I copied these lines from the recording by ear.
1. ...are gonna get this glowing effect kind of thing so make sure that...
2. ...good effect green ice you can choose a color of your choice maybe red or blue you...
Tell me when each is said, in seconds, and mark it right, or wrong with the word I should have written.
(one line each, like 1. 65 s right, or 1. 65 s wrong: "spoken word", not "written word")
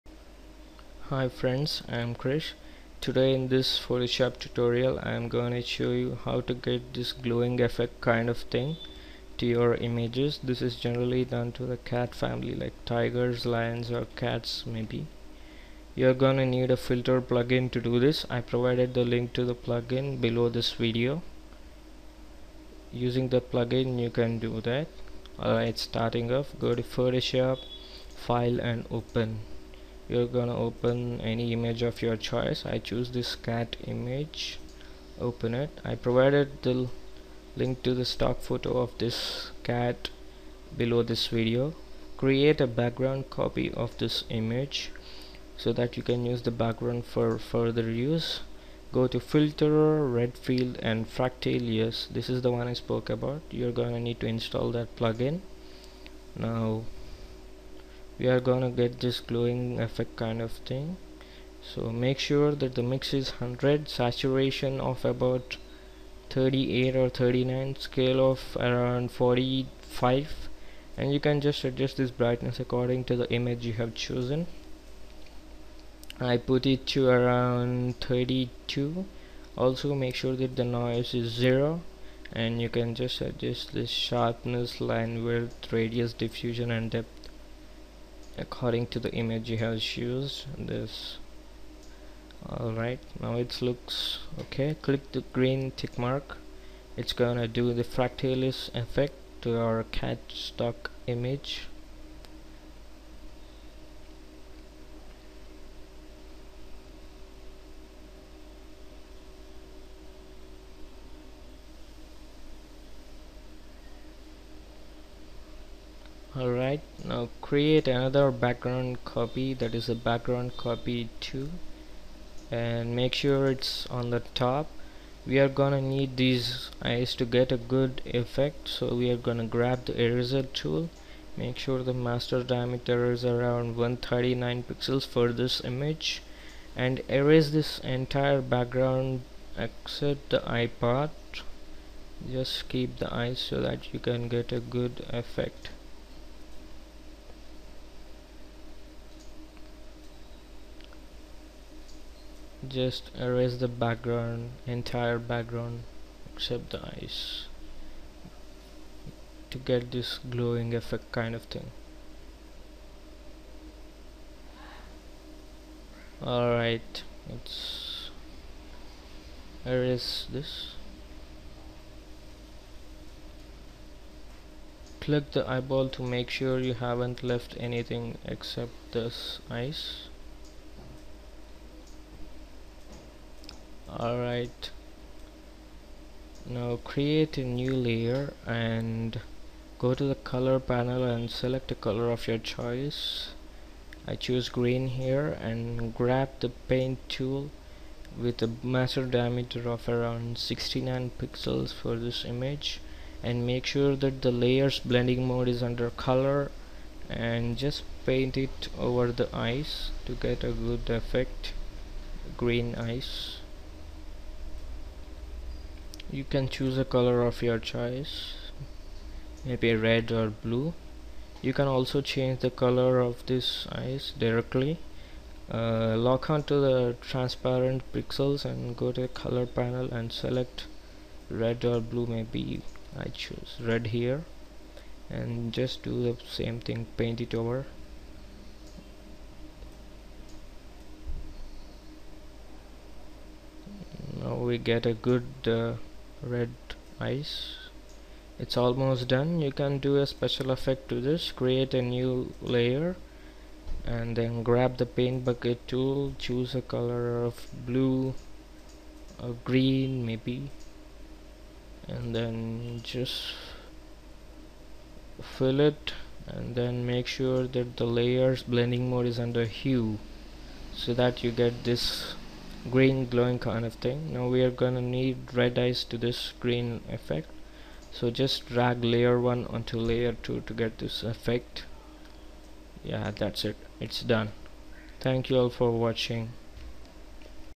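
1. 58 s right
2. 210 s right.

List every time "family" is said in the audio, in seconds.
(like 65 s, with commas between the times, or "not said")
12 s.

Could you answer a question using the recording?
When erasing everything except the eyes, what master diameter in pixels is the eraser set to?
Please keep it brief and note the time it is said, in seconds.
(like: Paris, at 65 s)
139 pixels, at 133 s.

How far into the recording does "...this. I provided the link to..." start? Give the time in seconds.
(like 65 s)
17 s.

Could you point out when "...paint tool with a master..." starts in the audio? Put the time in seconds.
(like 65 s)
196 s.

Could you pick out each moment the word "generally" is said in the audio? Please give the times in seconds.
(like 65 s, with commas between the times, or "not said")
10 s.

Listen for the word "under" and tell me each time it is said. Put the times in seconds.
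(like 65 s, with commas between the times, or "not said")
205 s, 269 s.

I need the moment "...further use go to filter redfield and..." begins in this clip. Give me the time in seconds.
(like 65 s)
47 s.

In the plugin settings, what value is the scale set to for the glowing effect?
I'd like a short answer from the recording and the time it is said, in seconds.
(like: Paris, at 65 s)
45, at 69 s.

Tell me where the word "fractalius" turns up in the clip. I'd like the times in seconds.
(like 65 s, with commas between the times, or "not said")
51 s, 97 s.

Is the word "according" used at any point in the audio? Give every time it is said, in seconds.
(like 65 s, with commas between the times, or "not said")
72 s, 88 s.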